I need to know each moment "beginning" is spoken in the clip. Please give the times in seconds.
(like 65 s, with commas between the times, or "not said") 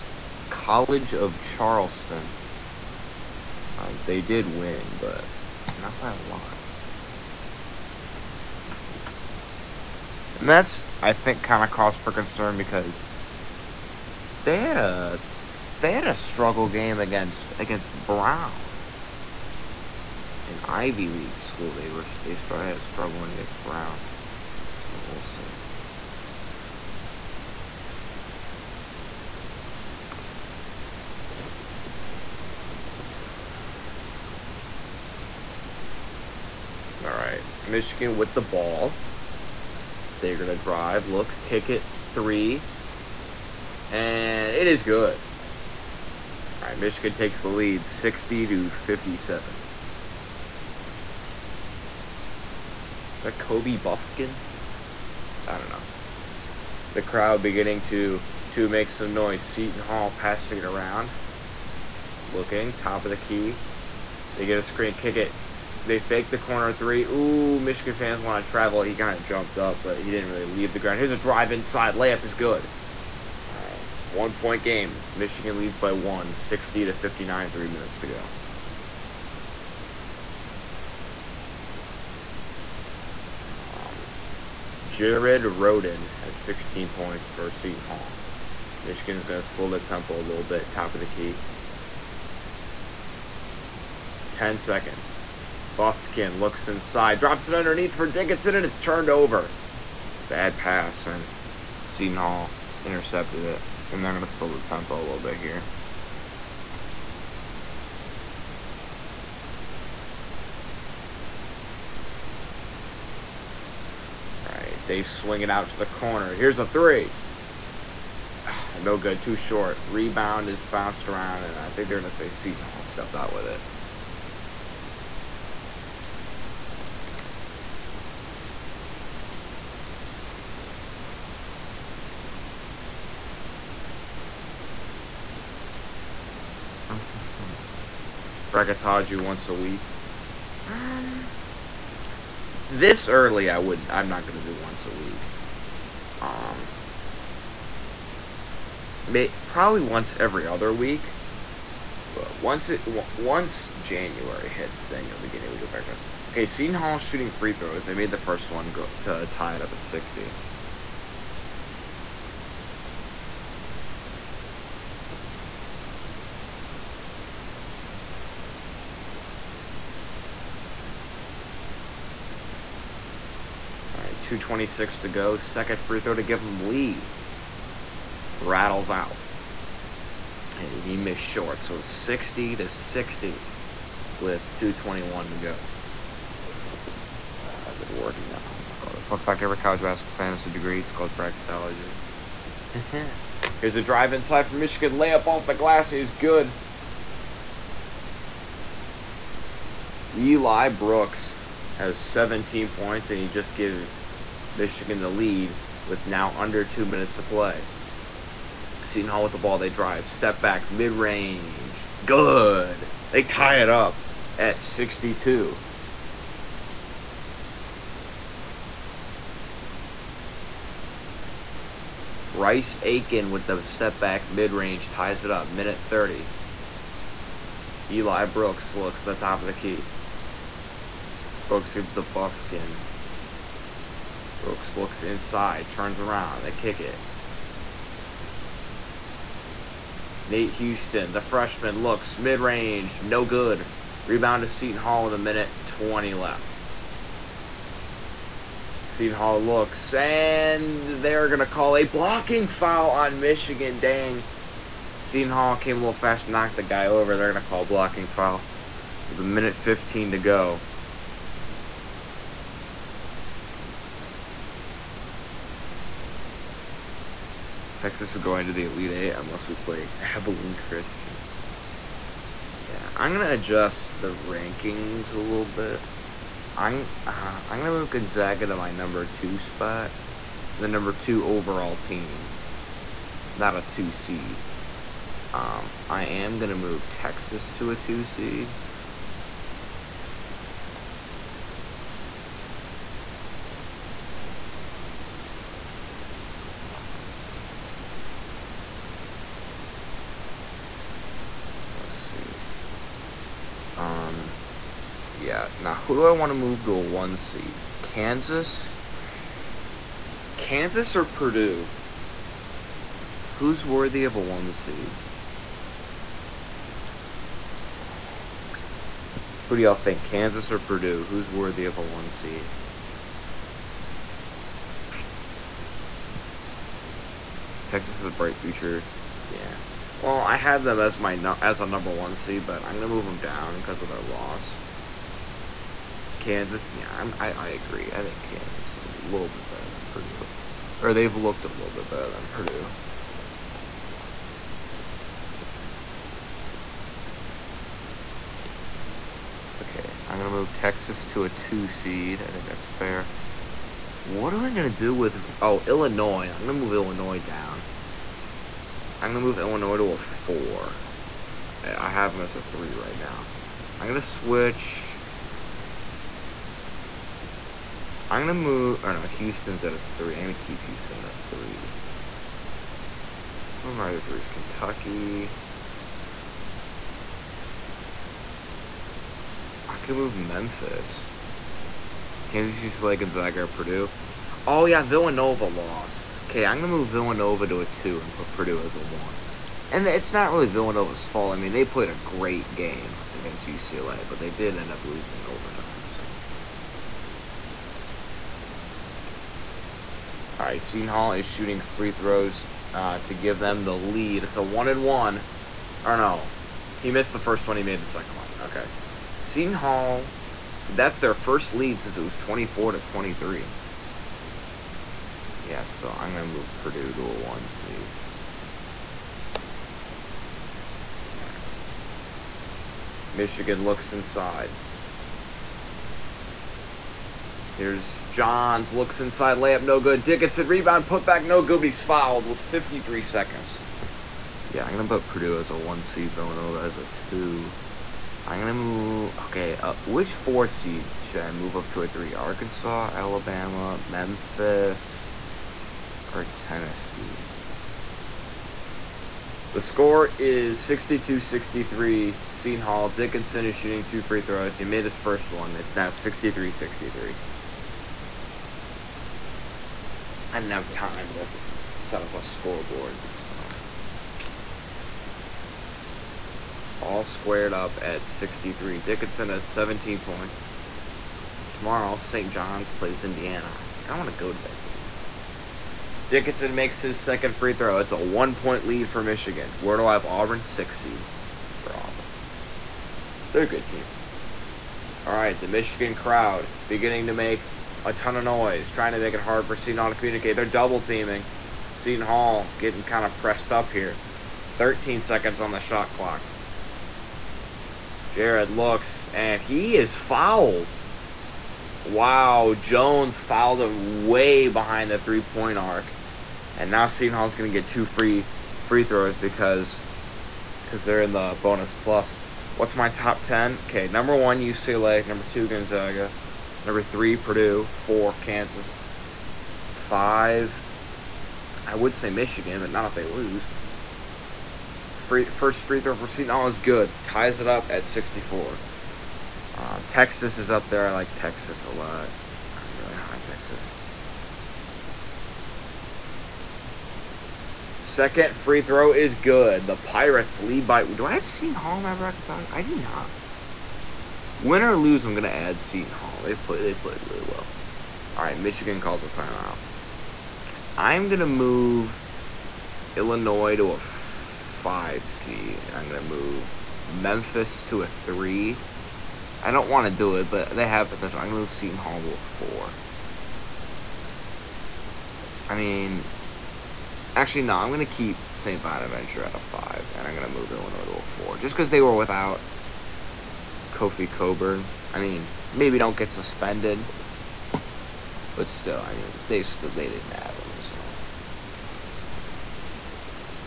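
57 s, 486 s.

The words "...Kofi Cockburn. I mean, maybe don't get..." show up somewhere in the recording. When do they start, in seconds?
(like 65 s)
573 s.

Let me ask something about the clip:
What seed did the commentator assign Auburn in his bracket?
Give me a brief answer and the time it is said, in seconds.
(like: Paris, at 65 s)
6, at 480 s.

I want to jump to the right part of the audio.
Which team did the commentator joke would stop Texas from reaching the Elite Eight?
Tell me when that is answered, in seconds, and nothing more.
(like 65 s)
269 s.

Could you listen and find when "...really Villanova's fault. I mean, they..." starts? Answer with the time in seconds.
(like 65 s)
390 s.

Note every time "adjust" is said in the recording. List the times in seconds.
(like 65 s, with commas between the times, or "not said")
273 s.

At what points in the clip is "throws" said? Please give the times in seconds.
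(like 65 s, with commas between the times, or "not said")
157 s, 175 s, 401 s, 454 s, 477 s, 508 s, 525 s, 538 s.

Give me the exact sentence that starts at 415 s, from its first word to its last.
Yeah, so I'm going to move Purdue to a one seed.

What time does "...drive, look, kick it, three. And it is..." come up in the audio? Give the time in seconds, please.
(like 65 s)
40 s.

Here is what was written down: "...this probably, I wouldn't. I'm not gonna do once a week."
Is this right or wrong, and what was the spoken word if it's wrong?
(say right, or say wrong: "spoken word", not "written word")
wrong: "early", not "probably".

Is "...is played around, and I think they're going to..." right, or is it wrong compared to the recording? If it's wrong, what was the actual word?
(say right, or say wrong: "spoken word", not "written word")
wrong: "bounced", not "played".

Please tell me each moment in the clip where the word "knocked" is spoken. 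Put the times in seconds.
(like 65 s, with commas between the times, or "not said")
256 s.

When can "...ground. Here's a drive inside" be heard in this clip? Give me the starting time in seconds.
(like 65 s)
70 s.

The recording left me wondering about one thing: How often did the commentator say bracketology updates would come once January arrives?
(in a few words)
weekly.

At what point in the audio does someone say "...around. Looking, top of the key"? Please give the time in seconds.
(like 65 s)
60 s.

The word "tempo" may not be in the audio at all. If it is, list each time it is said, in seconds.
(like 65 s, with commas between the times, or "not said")
89 s, 104 s.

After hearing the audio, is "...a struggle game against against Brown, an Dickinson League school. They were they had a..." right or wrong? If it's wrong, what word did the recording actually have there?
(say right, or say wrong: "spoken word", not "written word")
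wrong: "Ivy", not "Dickinson".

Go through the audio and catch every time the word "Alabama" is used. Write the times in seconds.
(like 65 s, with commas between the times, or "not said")
442 s.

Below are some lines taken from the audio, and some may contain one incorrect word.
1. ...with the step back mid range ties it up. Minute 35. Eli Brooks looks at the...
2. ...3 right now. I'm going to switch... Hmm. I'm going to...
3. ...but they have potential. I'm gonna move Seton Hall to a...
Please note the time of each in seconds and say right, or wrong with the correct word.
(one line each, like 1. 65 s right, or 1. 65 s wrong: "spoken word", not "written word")
1. 223 s wrong: "30", not "35"
2. 362 s right
3. 560 s right.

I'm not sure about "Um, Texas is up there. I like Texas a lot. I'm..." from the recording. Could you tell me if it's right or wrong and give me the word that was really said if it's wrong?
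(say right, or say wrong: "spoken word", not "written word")
right.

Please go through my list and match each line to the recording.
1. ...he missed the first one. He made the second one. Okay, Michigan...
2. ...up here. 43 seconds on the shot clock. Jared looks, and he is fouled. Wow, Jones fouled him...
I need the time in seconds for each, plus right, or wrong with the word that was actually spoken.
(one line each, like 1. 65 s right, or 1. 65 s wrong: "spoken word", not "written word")
1. 406 s wrong: "Seton", not "Michigan"
2. 493 s wrong: "13", not "43".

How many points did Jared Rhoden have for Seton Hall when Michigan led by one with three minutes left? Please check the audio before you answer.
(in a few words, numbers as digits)
16.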